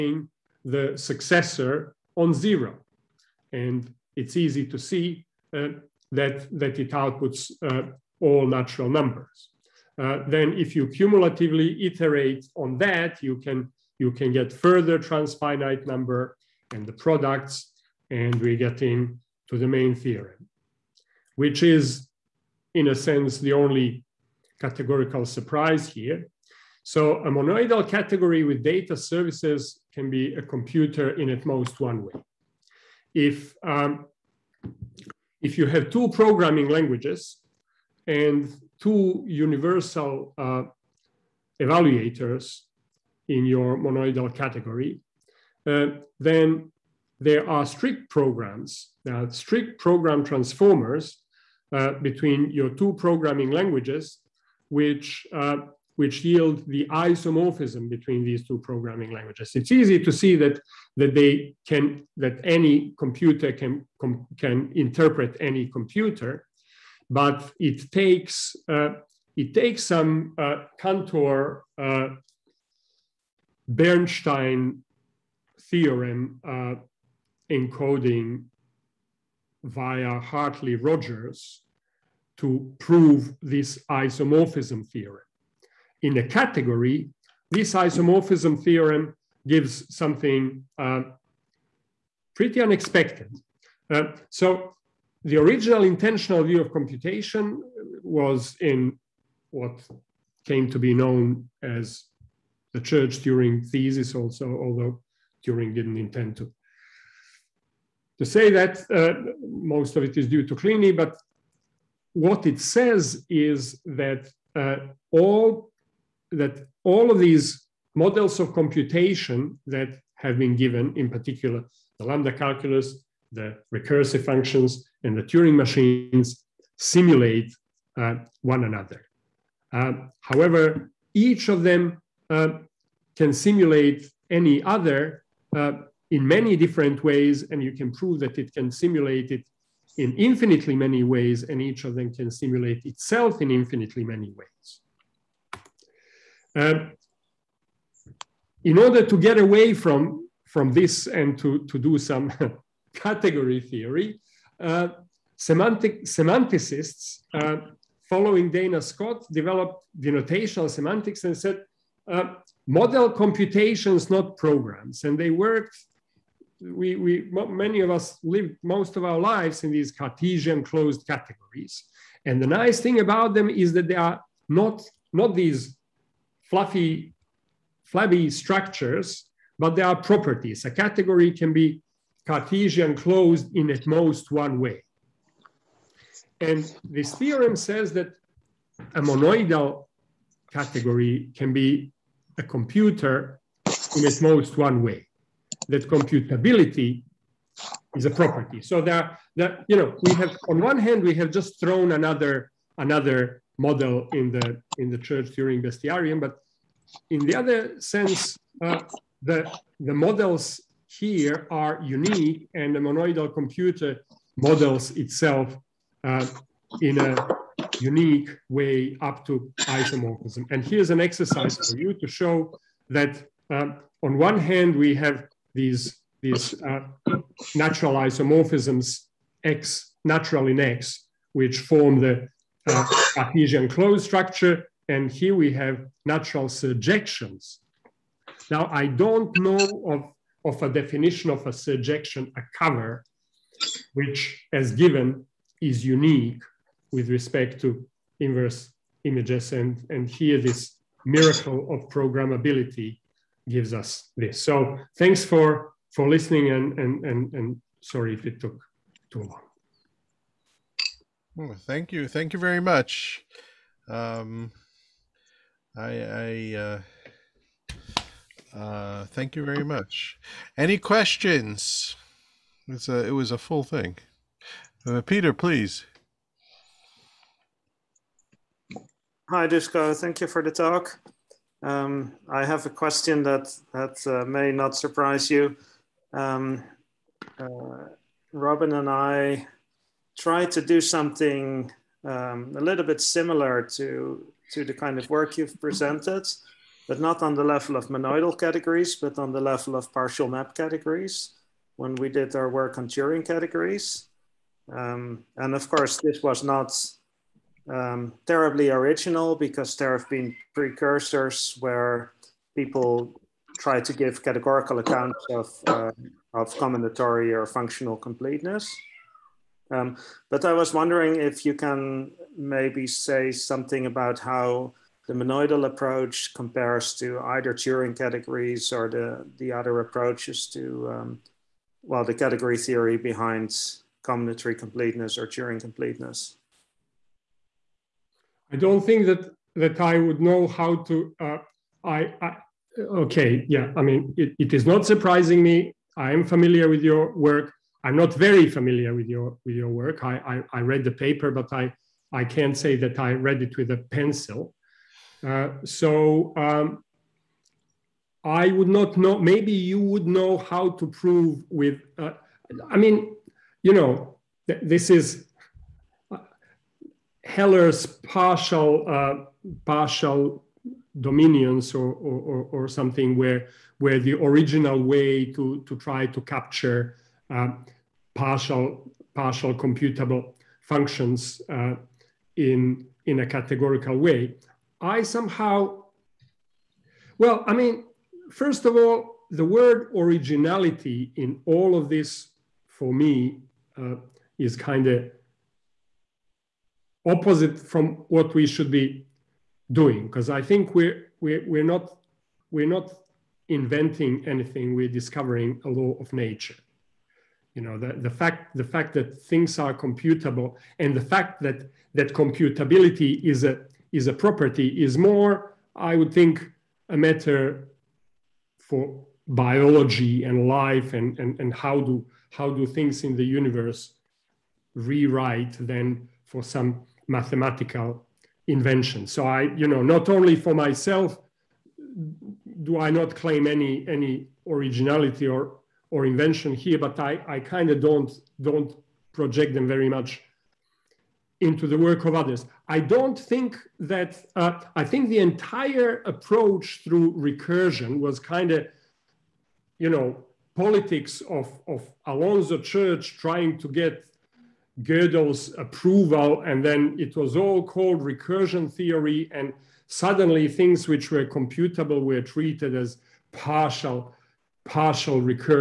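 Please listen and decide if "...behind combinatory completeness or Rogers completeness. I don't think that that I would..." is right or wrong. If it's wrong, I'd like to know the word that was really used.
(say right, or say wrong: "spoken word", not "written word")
wrong: "Turing", not "Rogers".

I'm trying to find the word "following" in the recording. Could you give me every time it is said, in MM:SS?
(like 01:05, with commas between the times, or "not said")
02:38.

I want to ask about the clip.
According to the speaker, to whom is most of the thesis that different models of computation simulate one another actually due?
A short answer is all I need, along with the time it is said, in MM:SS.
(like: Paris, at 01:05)
Kleene, at 01:50.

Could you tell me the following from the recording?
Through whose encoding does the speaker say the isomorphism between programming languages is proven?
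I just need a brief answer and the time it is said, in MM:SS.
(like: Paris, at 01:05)
Hartley Rogers, at 01:20.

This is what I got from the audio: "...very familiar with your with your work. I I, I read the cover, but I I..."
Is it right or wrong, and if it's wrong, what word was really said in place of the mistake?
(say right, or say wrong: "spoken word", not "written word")
wrong: "paper", not "cover".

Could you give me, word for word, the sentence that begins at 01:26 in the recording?
In a category, this isomorphism theorem gives something uh, pretty unexpected.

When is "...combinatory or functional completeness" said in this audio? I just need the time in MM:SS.
05:16.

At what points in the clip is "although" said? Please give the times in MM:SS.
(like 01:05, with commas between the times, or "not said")
01:44.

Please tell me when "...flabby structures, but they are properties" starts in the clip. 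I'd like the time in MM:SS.
02:57.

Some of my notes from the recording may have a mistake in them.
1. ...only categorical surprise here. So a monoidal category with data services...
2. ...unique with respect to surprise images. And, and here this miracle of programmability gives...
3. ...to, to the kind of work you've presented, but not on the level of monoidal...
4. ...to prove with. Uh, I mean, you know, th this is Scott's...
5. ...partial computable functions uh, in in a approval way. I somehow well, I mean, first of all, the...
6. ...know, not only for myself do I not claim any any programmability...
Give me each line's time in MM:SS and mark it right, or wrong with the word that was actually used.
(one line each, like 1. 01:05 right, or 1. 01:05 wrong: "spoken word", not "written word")
1. 00:23 right
2. 04:05 wrong: "inverse", not "surprise"
3. 04:53 right
4. 06:00 wrong: "Heller", not "Scott"
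5. 06:19 wrong: "categorical", not "approval"
6. 07:09 wrong: "originality", not "programmability".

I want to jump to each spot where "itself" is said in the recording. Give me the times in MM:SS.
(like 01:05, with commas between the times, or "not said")
02:22, 03:35.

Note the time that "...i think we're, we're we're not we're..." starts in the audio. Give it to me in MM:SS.
06:40.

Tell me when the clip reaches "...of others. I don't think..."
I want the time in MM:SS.
07:22.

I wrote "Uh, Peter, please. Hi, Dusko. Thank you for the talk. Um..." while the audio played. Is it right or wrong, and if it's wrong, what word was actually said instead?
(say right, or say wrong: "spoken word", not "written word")
right.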